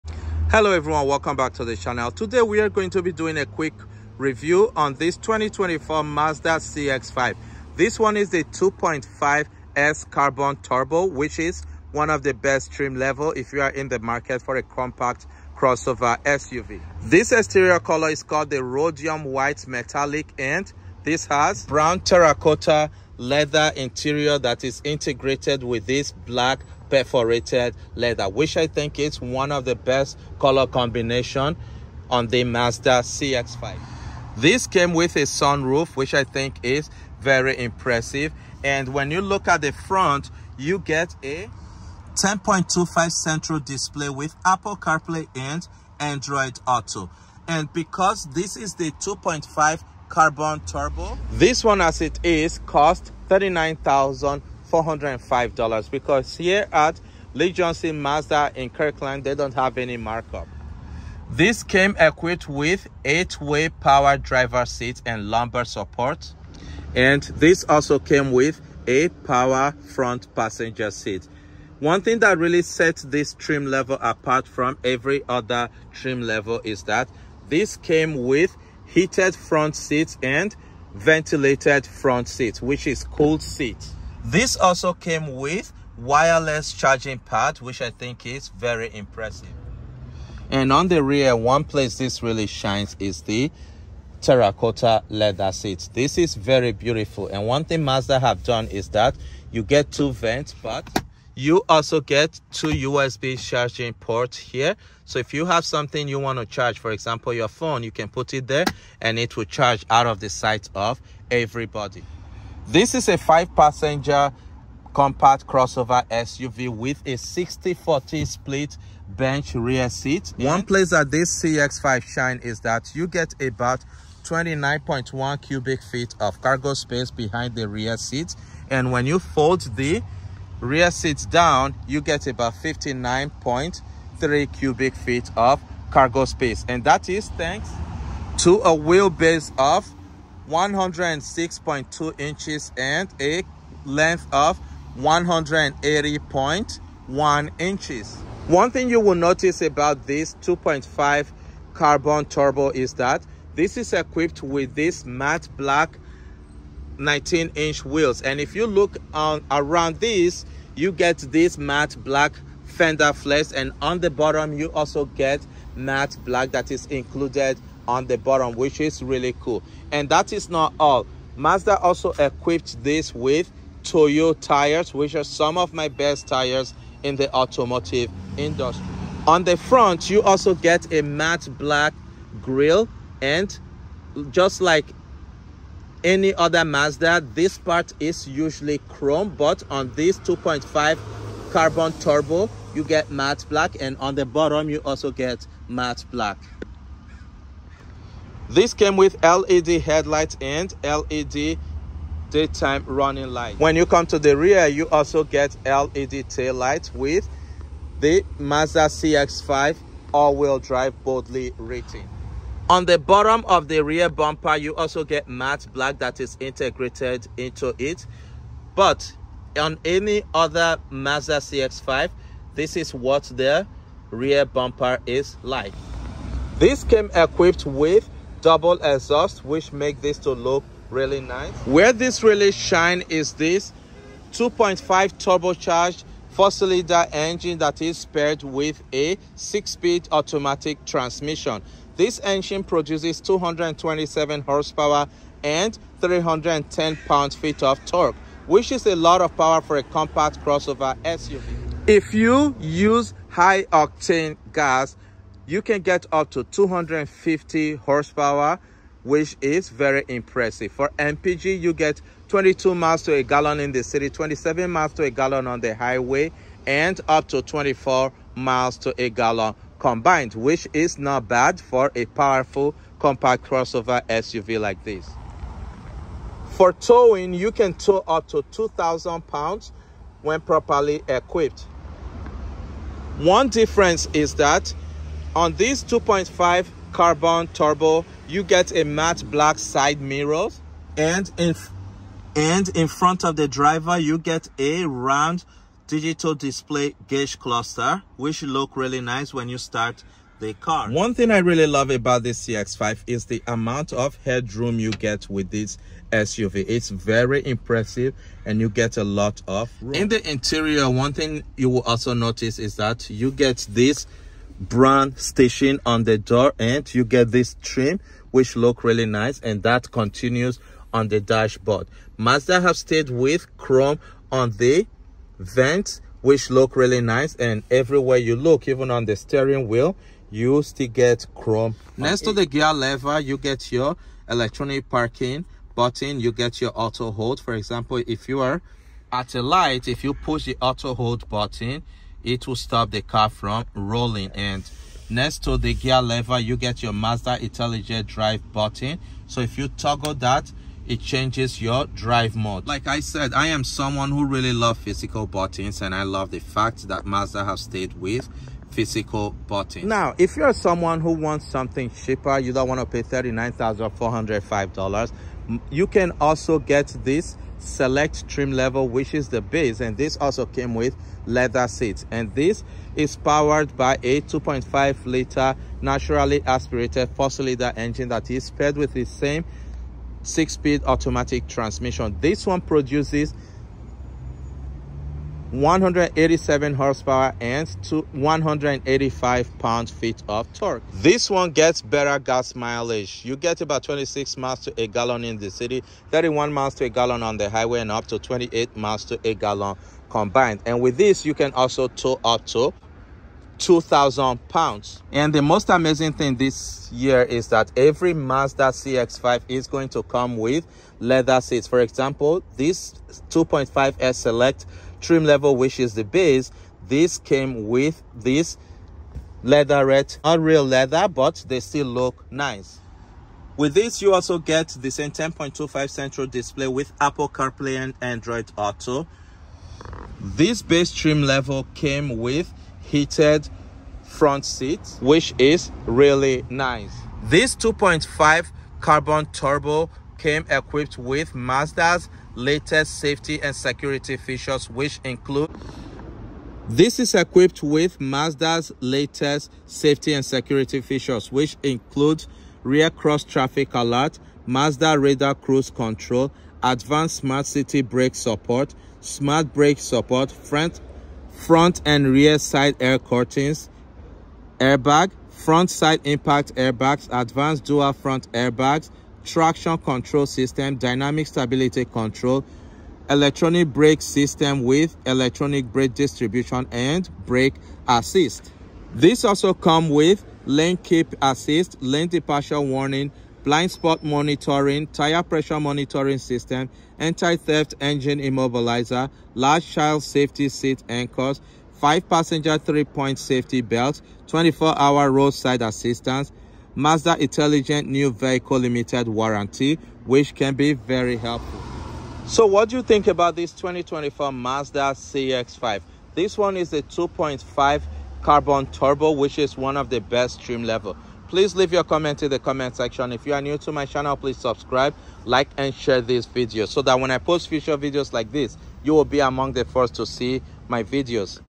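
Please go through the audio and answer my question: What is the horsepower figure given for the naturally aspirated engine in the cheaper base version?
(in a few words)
187.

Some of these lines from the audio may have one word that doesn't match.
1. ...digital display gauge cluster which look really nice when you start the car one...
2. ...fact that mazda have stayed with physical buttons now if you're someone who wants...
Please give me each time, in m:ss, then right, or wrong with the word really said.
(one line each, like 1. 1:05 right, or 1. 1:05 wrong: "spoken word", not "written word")
1. 4:55 right
2. 5:56 right.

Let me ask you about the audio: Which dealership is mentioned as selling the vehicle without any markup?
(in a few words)
Lee Johnson Mazda.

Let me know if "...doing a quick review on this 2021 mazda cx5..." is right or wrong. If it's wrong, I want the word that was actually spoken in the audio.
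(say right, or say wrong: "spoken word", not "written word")
wrong: "2024", not "2021".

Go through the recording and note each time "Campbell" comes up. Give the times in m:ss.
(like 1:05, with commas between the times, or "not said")
not said.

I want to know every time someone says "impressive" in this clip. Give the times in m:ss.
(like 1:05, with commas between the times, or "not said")
0:37, 1:28, 4:20, 5:07.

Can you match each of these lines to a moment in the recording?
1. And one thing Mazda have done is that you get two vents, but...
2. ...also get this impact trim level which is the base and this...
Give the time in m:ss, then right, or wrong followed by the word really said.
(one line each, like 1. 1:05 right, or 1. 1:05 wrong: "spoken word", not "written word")
1. 1:37 right
2. 6:06 wrong: "select", not "impact".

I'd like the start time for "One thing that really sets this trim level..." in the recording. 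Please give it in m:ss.
1:11.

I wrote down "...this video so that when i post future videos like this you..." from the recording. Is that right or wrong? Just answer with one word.
right.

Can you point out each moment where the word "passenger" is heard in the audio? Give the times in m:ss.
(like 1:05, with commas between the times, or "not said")
1:10, 1:53, 8:11.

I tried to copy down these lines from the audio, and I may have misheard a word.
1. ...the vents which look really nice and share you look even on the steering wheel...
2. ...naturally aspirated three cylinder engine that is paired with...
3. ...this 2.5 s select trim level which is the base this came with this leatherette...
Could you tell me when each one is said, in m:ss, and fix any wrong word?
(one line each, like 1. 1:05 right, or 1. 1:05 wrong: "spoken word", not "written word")
1. 5:24 wrong: "everywhere", not "share"
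2. 6:15 wrong: "four", not "three"
3. 6:52 right.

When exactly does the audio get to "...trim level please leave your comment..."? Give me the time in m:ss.
8:30.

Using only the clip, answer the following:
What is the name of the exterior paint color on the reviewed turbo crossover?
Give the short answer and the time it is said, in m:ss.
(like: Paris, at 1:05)
Rhodium White Metallic, at 0:18.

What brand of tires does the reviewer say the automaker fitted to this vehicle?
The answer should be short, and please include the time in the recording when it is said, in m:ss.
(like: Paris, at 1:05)
Toyo, at 2:53.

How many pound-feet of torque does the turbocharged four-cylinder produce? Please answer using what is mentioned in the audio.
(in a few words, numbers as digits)
310.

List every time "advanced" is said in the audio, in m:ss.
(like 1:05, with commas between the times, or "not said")
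7:36, 7:47.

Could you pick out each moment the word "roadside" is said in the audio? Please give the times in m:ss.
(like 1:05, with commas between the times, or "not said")
8:15.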